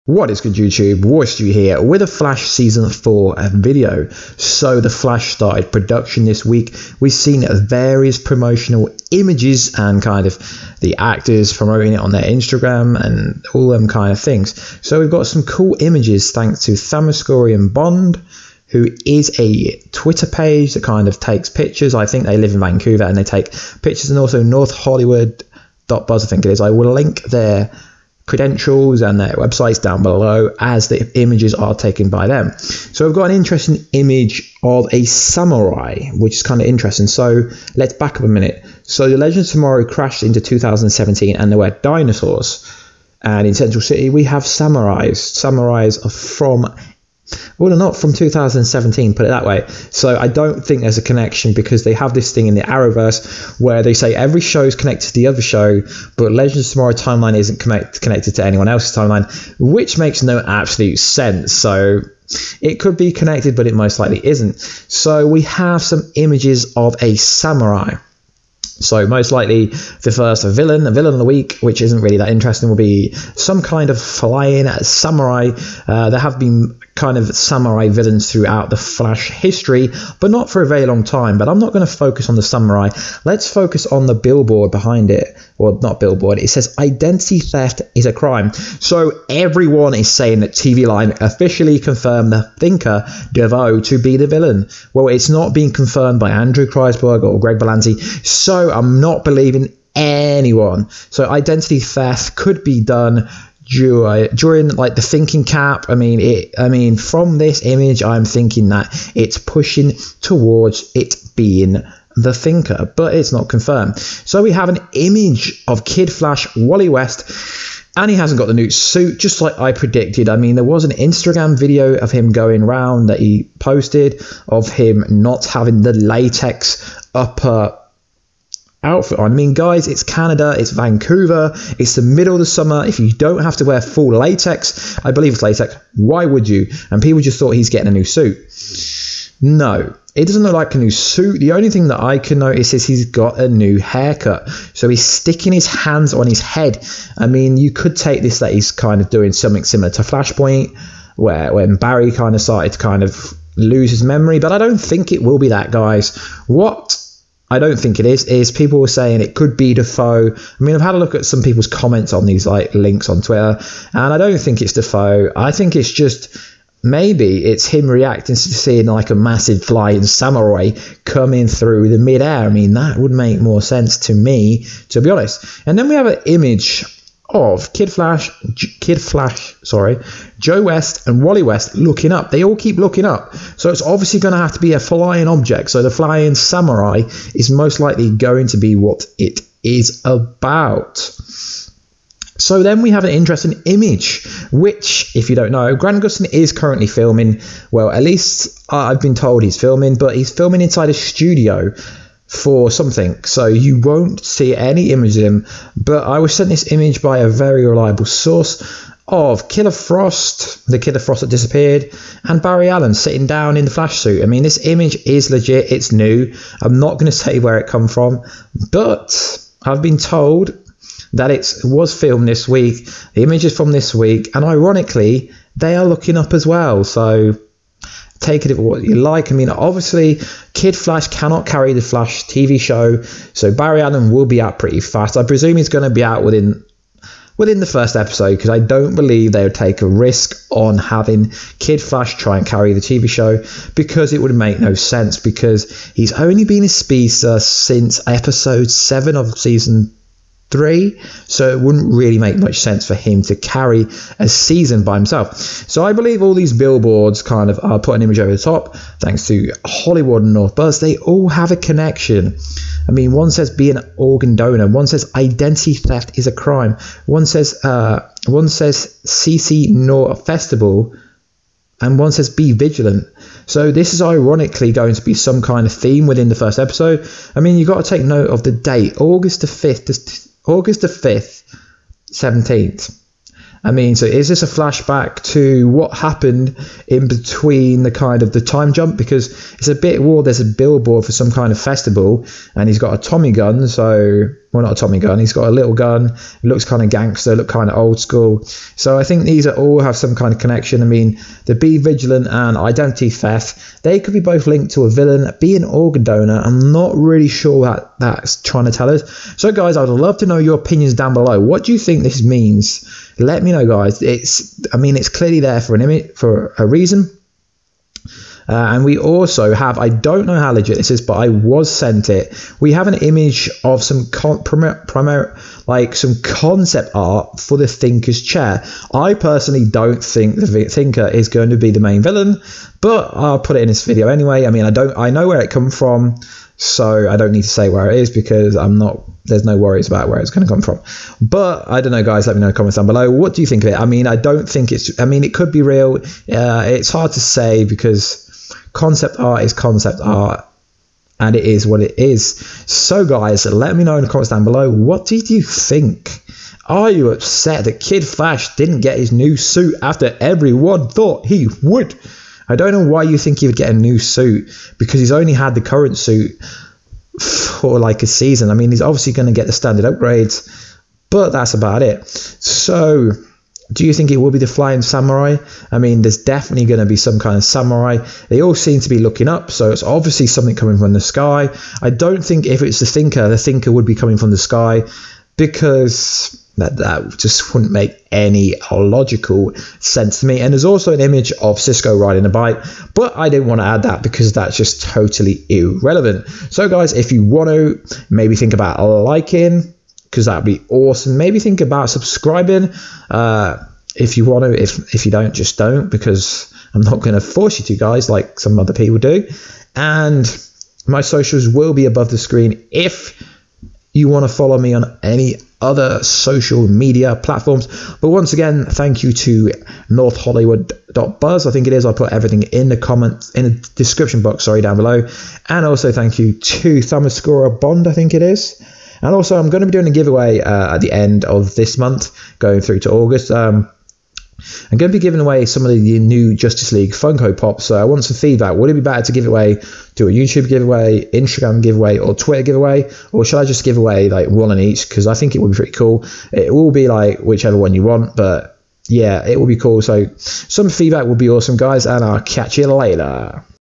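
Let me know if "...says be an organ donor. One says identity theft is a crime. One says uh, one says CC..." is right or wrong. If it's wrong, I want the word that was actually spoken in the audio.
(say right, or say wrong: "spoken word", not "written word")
right.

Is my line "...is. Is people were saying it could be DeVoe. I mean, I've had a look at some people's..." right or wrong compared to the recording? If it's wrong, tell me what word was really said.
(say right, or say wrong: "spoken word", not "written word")
right.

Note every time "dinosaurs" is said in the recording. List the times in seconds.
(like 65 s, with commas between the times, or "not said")
41 s.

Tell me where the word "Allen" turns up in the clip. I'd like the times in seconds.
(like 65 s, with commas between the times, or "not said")
212 s, 233 s.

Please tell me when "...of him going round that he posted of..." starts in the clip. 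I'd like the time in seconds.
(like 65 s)
121 s.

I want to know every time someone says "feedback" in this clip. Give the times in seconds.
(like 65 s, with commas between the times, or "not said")
438 s, 450 s.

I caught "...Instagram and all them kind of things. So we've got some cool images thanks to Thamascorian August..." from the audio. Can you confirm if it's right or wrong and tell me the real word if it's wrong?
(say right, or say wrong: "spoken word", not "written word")
wrong: "Bond", not "August".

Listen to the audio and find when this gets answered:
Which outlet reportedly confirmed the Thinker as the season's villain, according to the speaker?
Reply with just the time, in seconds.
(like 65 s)
90 s.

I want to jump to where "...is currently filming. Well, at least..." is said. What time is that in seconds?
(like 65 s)
196 s.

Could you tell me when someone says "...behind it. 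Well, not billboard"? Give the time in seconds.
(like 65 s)
84 s.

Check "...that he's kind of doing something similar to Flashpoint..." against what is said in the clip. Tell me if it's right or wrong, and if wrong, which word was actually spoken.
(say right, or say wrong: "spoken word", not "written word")
right.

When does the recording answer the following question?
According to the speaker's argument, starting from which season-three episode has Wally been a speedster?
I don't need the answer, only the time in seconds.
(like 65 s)
248 s.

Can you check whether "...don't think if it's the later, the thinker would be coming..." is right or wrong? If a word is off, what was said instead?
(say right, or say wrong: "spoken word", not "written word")
wrong: "thinker", not "later".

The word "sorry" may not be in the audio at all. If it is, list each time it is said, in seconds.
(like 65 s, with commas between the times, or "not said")
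179 s, 424 s.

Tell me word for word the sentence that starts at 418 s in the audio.
But once again, thank you to North Hollywood Buzz.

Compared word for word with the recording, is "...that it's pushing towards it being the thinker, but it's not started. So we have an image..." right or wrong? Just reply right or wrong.
wrong.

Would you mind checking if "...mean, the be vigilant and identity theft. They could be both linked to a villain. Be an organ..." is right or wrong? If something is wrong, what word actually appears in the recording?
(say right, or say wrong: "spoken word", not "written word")
right.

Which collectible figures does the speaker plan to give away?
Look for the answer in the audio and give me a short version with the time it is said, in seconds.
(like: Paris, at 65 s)
Justice League Funko Pops, at 436 s.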